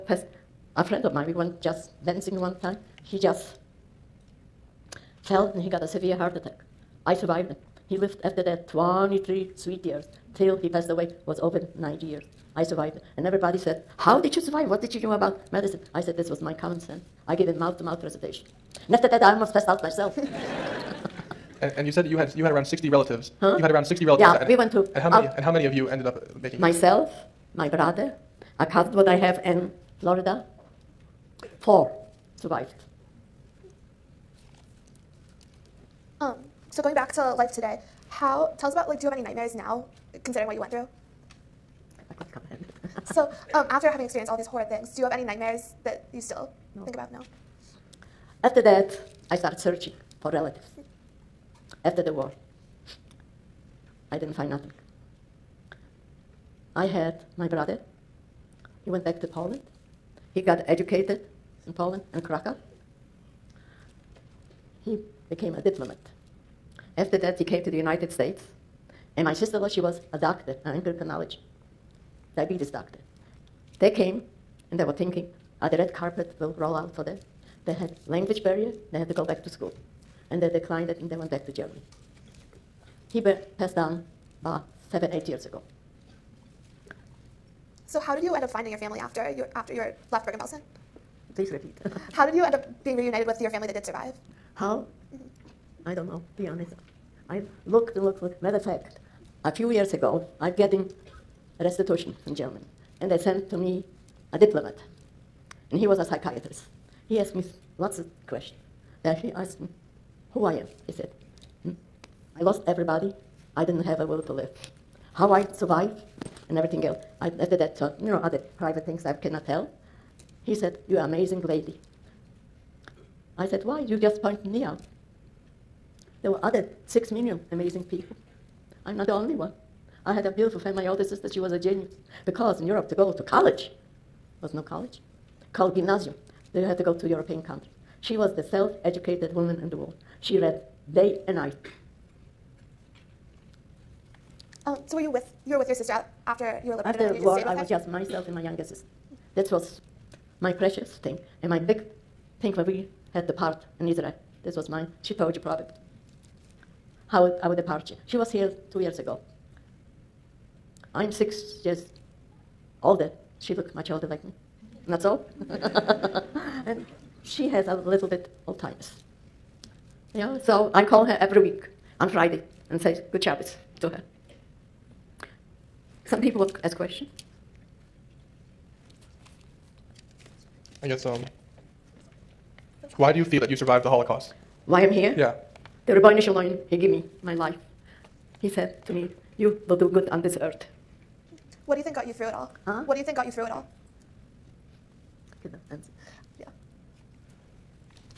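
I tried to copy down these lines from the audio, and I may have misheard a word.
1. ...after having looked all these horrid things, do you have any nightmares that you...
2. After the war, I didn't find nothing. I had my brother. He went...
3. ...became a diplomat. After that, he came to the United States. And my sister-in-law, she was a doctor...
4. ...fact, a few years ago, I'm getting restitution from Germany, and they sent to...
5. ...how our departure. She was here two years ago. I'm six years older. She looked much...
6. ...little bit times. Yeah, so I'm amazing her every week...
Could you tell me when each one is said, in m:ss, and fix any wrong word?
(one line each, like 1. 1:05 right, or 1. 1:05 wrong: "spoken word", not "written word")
1. 0:43 wrong: "experienced", not "looked"
2. 0:51 right
3. 1:05 right
4. 1:38 right
5. 2:37 right
6. 2:47 wrong: "calling", not "amazing".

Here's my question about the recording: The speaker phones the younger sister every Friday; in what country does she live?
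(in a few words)
Israel.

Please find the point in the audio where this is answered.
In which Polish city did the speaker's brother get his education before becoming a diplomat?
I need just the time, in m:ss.
1:02.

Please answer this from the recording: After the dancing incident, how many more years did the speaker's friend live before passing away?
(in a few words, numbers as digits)
23.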